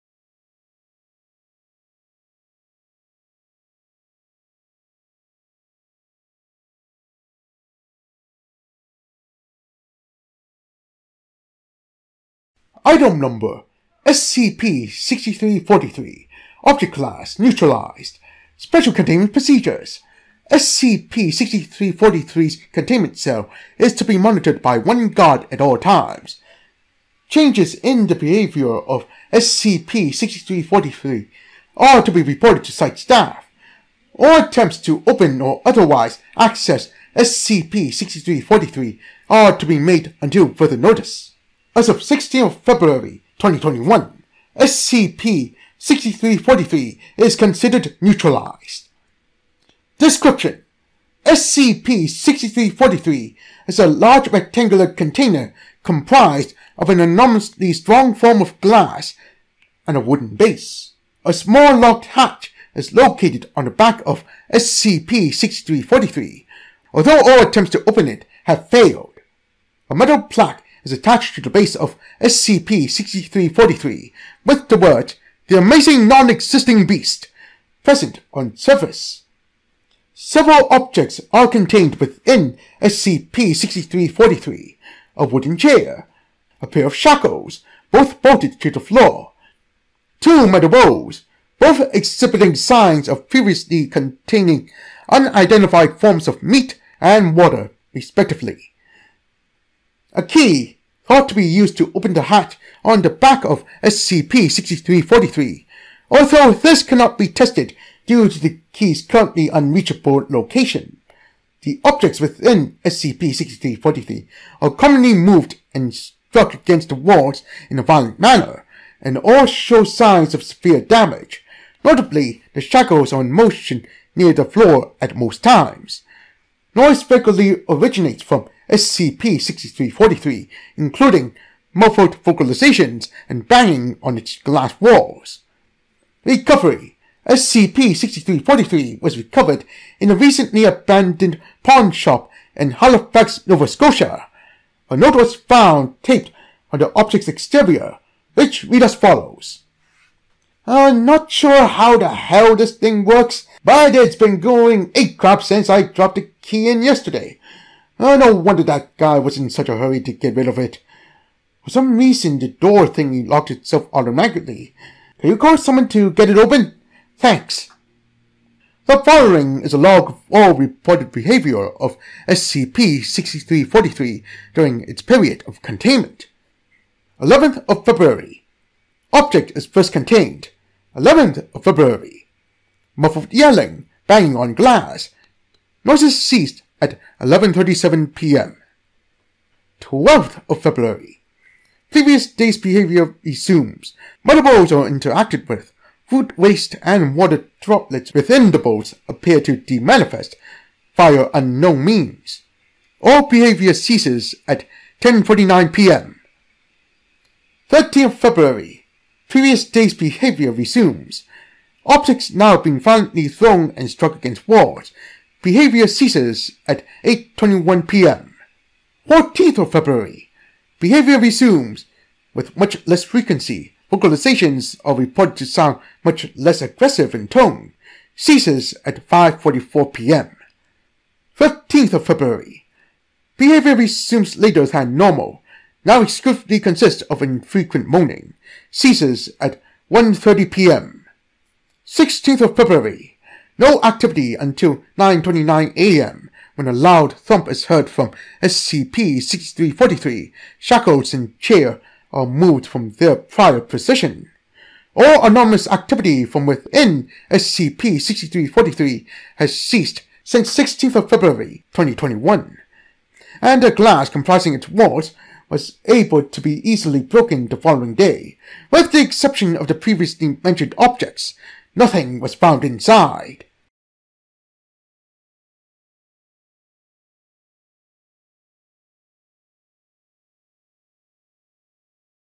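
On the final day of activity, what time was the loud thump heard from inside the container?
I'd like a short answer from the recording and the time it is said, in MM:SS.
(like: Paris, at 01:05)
9:29 a.m., at 04:04.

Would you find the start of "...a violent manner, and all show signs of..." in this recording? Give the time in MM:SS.
01:57.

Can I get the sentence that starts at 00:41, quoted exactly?
As of 16 February 2021, SCP-6343 is considered neutralized.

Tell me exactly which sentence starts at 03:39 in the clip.
14th of February, behavior resumes with much less frequency.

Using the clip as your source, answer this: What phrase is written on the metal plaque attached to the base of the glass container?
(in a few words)
The Amazing Non-Existing Beast.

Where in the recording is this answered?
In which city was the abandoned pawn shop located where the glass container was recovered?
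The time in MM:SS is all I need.
02:22.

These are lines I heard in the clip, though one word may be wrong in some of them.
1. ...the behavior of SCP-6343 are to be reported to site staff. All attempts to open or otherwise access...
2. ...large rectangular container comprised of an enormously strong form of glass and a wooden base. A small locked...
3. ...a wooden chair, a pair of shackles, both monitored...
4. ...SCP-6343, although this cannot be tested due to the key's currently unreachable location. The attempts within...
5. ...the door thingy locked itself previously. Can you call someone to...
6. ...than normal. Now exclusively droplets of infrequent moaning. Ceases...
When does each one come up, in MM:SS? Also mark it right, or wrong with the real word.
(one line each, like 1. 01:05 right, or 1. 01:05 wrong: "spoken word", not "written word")
1. 00:28 right
2. 00:53 right
3. 01:25 wrong: "bolted", not "monitored"
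4. 01:43 wrong: "objects", not "attempts"
5. 02:42 wrong: "automatically", not "previously"
6. 03:54 wrong: "consists", not "droplets".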